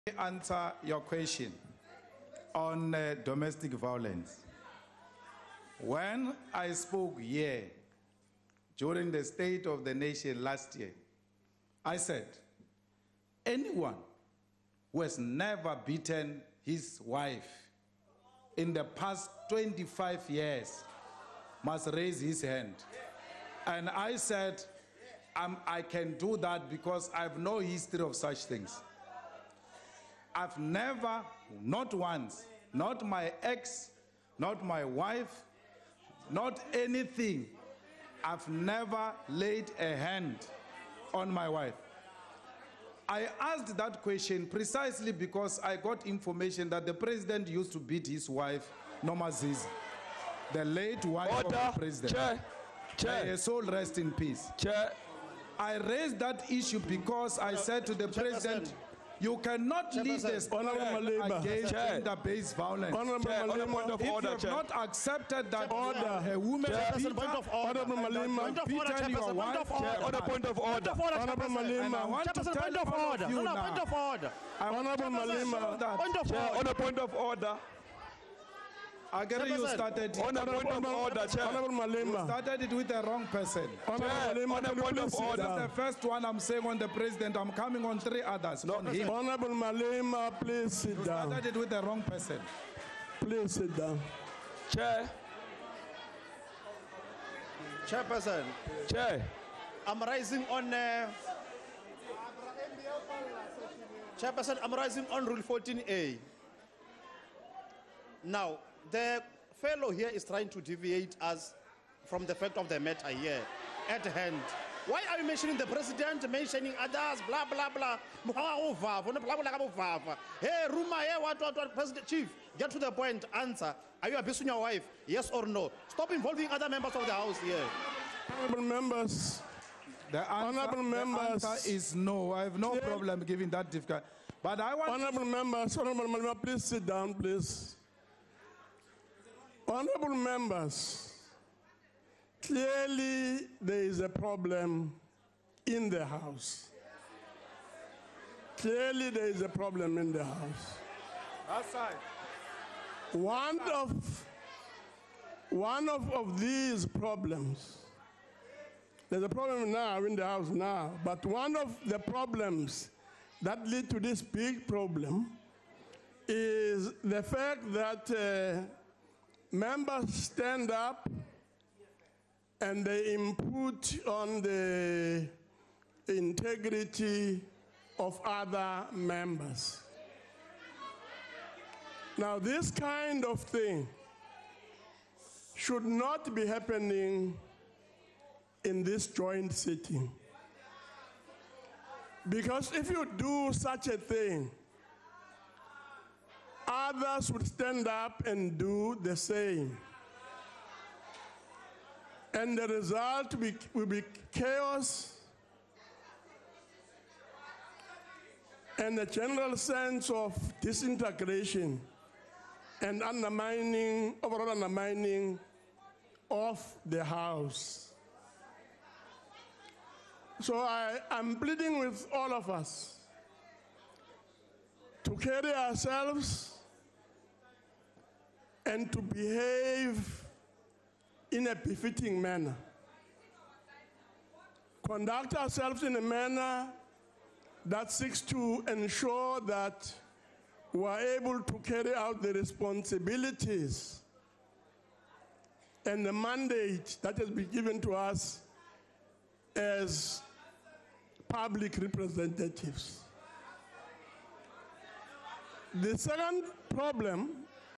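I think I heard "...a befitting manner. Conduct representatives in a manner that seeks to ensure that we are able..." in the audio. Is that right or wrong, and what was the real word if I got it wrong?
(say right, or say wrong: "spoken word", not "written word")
wrong: "ourselves", not "representatives".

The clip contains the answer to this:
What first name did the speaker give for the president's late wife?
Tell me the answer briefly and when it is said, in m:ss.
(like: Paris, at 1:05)
Nomazizi, at 0:49.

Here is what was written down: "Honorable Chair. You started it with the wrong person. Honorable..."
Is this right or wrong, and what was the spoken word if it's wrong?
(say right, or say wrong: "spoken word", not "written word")
wrong: "Malema", not "Chair".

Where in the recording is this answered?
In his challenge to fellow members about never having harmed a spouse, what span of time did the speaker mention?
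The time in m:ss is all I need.
0:19.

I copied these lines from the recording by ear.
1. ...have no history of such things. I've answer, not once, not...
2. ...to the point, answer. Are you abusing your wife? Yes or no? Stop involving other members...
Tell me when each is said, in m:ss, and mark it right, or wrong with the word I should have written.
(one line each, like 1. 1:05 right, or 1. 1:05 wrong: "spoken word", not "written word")
1. 0:27 wrong: "never", not "answer"
2. 2:02 right.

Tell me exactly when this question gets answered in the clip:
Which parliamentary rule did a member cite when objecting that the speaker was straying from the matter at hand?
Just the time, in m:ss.
1:45.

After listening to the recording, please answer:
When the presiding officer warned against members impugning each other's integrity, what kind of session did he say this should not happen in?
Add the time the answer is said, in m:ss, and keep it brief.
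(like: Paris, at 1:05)
joint sitting, at 3:09.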